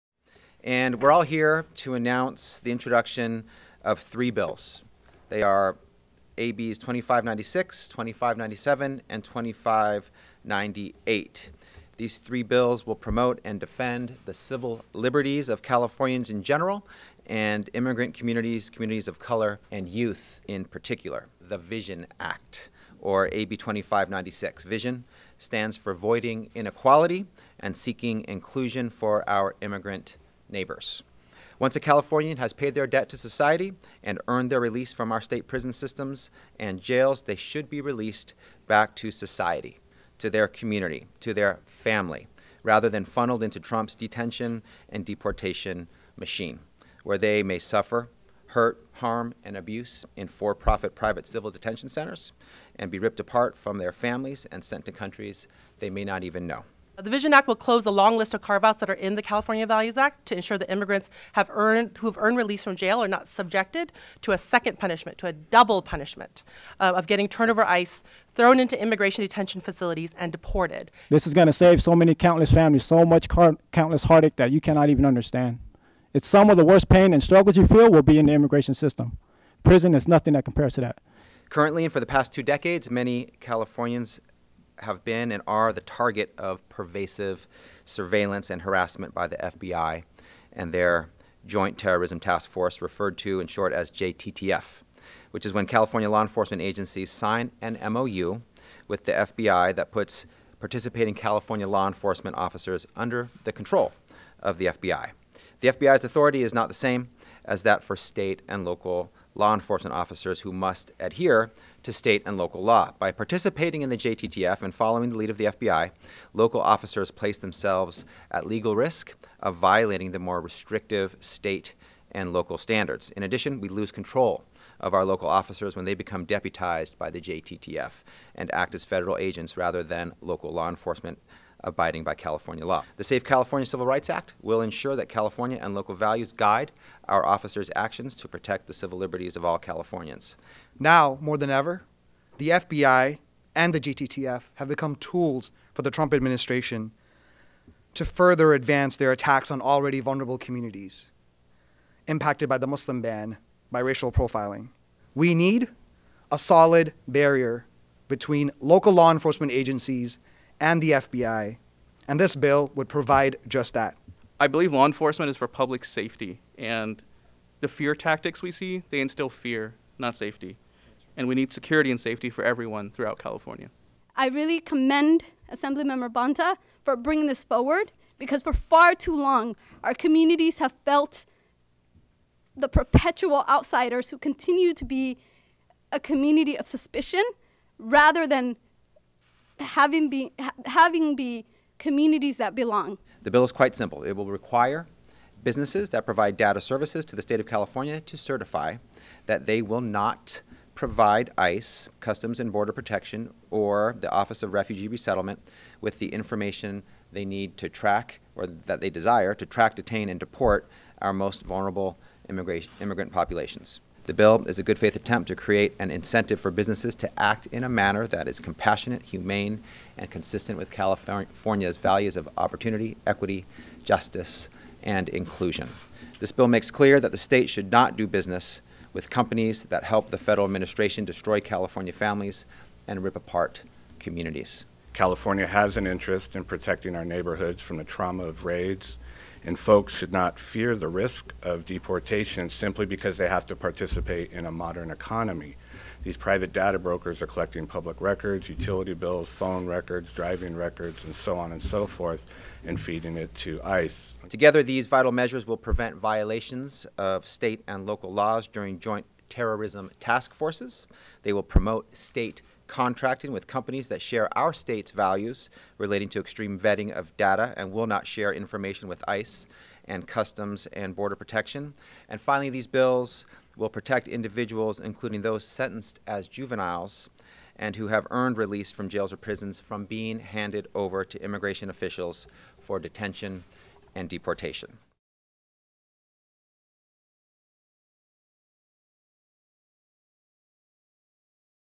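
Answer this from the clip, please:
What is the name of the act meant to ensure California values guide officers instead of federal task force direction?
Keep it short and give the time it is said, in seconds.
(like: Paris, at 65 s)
Safe California Civil Rights Act, at 133 s.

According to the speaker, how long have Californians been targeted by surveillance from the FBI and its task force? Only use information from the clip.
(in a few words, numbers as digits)
two decades.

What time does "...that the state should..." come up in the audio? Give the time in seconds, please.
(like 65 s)
226 s.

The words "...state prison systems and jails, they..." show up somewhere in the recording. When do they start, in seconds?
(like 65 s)
35 s.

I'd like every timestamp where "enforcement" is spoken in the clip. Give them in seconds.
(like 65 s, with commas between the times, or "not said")
96 s, 101 s, 109 s, 130 s, 159 s, 164 s.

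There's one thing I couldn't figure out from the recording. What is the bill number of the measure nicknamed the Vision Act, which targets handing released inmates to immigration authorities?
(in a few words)
AB 2596.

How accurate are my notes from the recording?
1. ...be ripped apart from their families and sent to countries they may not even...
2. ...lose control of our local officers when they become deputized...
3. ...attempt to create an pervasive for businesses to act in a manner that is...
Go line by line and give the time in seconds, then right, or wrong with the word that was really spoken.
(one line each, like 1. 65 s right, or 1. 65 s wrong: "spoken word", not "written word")
1. 52 s right
2. 123 s right
3. 214 s wrong: "incentive", not "pervasive".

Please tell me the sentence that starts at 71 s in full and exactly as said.
This is going to save so many countless families so much countless heartache that you cannot even understand.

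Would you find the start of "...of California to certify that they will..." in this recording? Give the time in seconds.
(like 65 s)
197 s.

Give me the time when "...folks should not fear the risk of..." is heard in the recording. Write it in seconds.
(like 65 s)
239 s.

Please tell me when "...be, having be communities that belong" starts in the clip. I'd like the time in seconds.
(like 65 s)
190 s.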